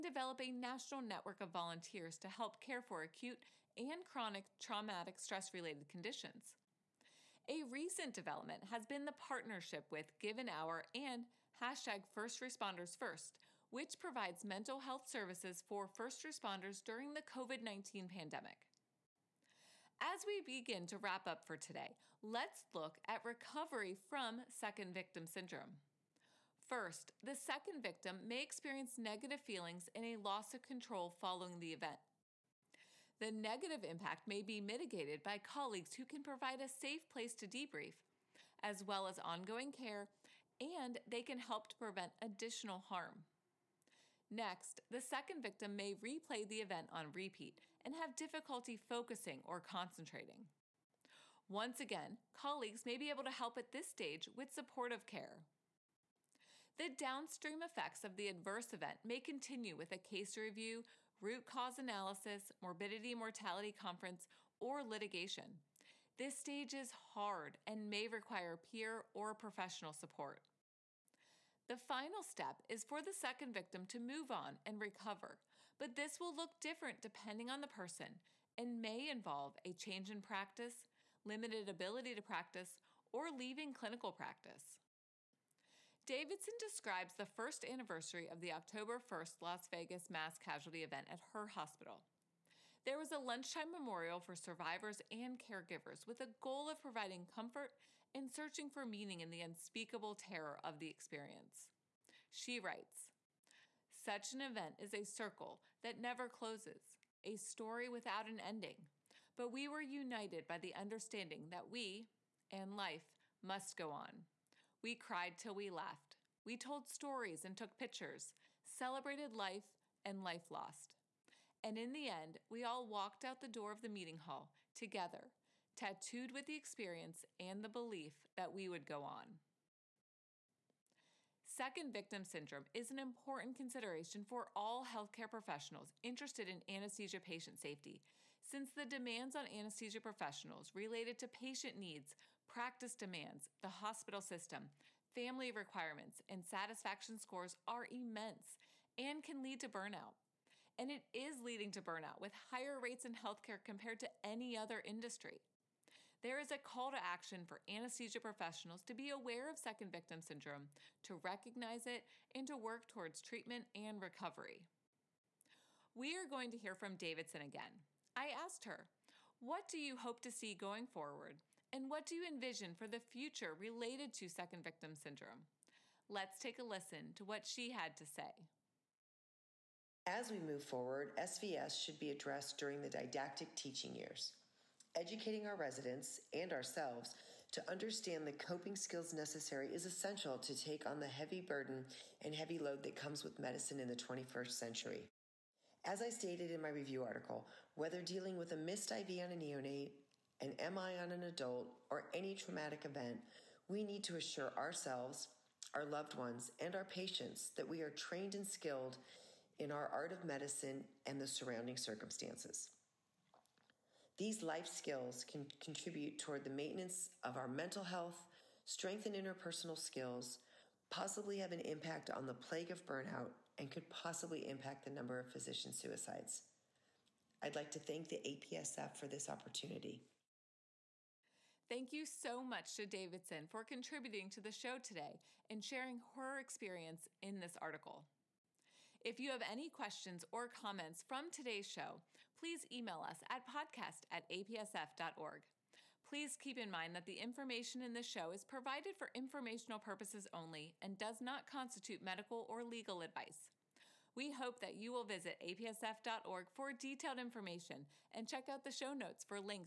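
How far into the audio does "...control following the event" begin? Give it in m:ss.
0:30.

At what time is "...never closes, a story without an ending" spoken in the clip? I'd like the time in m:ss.
1:45.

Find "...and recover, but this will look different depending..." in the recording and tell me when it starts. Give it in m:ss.
1:14.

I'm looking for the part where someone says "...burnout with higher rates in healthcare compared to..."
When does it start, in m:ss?
2:31.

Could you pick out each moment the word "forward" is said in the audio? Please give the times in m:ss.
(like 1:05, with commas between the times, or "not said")
2:50, 3:00.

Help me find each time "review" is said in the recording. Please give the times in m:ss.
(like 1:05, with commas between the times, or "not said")
1:00, 3:16.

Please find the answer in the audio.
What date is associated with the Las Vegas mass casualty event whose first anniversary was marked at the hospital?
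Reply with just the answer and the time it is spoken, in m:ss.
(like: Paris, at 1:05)
October 1st, at 1:28.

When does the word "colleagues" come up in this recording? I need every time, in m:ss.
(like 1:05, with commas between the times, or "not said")
0:35, 0:52.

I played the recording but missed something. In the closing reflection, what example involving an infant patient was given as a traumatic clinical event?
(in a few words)
a missed IV on a neonate.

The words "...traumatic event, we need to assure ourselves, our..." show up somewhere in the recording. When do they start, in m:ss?
3:22.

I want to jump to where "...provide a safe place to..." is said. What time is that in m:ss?
0:36.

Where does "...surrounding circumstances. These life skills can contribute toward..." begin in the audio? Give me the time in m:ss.
3:31.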